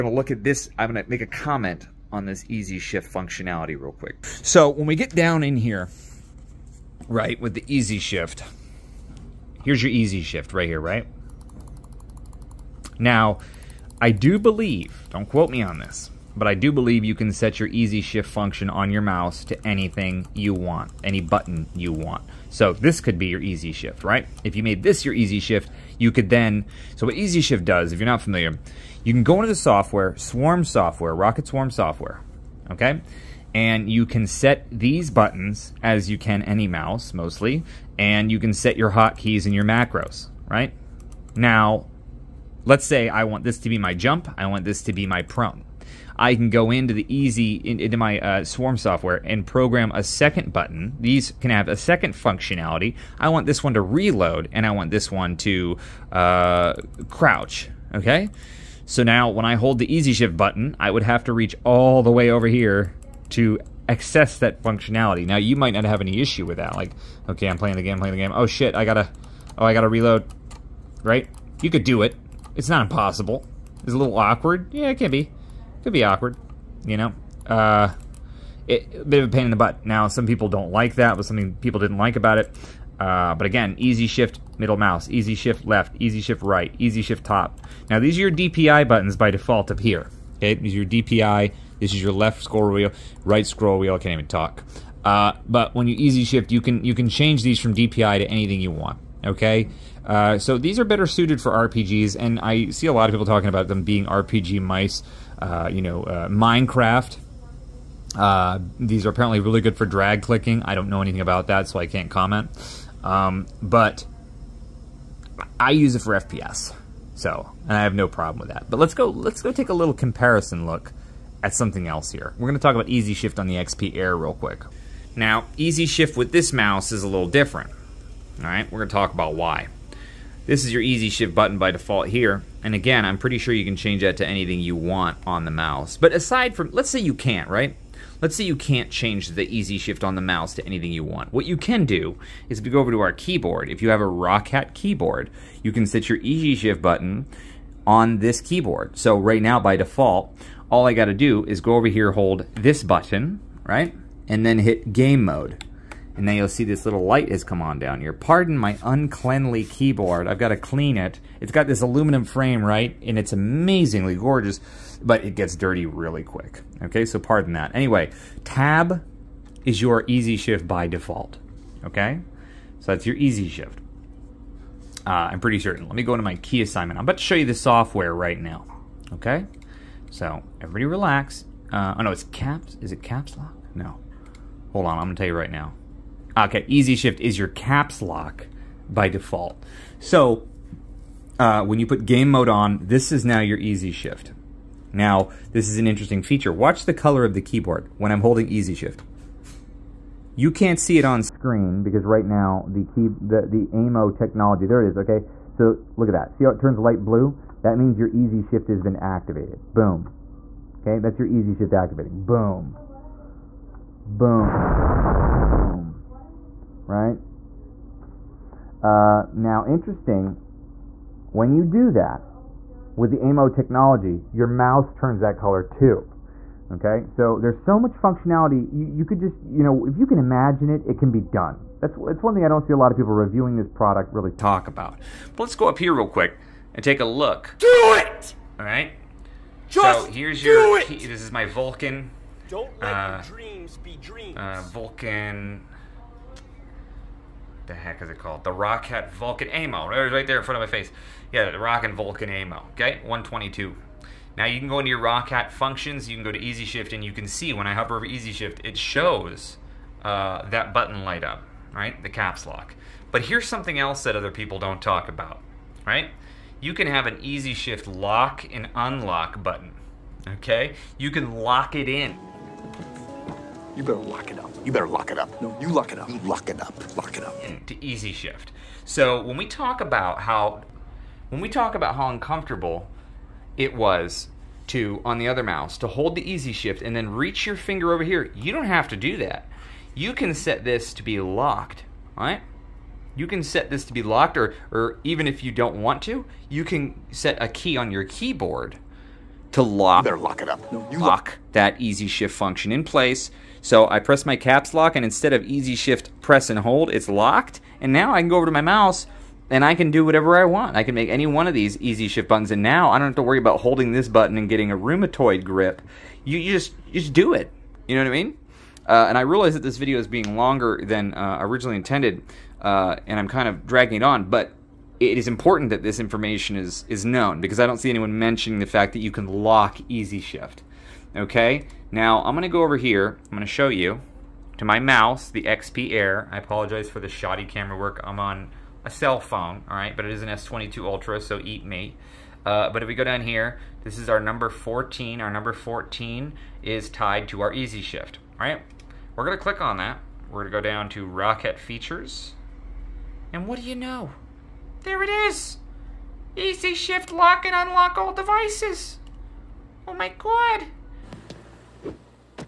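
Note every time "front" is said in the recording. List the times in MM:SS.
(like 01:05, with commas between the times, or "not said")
04:10.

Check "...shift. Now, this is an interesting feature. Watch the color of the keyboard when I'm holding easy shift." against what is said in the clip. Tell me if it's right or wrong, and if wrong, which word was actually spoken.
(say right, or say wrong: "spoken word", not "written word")
right.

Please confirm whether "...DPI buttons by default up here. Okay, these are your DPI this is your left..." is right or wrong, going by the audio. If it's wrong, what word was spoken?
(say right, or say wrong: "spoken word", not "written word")
right.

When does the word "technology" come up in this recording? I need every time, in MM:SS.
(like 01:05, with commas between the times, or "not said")
03:24, 03:43.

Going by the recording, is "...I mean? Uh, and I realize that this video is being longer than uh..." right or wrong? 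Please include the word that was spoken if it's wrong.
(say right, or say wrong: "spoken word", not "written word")
right.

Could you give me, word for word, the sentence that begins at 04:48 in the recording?
You don't have to do that.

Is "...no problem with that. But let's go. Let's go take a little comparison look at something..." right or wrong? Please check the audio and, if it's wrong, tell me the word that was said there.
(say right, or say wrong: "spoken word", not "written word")
right.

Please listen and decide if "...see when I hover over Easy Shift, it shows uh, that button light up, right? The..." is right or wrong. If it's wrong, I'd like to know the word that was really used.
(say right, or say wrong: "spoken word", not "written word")
right.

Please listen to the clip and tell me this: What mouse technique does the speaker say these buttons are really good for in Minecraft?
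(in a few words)
Drag clicking.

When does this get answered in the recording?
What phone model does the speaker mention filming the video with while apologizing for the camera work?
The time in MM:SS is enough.
05:40.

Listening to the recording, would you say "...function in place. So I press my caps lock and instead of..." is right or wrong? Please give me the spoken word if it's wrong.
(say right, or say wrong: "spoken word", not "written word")
right.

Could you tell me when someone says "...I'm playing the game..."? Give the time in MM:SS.
01:07.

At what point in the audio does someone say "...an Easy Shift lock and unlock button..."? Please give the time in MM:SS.
04:27.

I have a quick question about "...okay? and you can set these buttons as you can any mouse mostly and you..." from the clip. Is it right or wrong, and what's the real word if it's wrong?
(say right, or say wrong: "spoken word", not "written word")
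right.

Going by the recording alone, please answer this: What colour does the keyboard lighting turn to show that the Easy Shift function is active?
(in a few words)
Light blue.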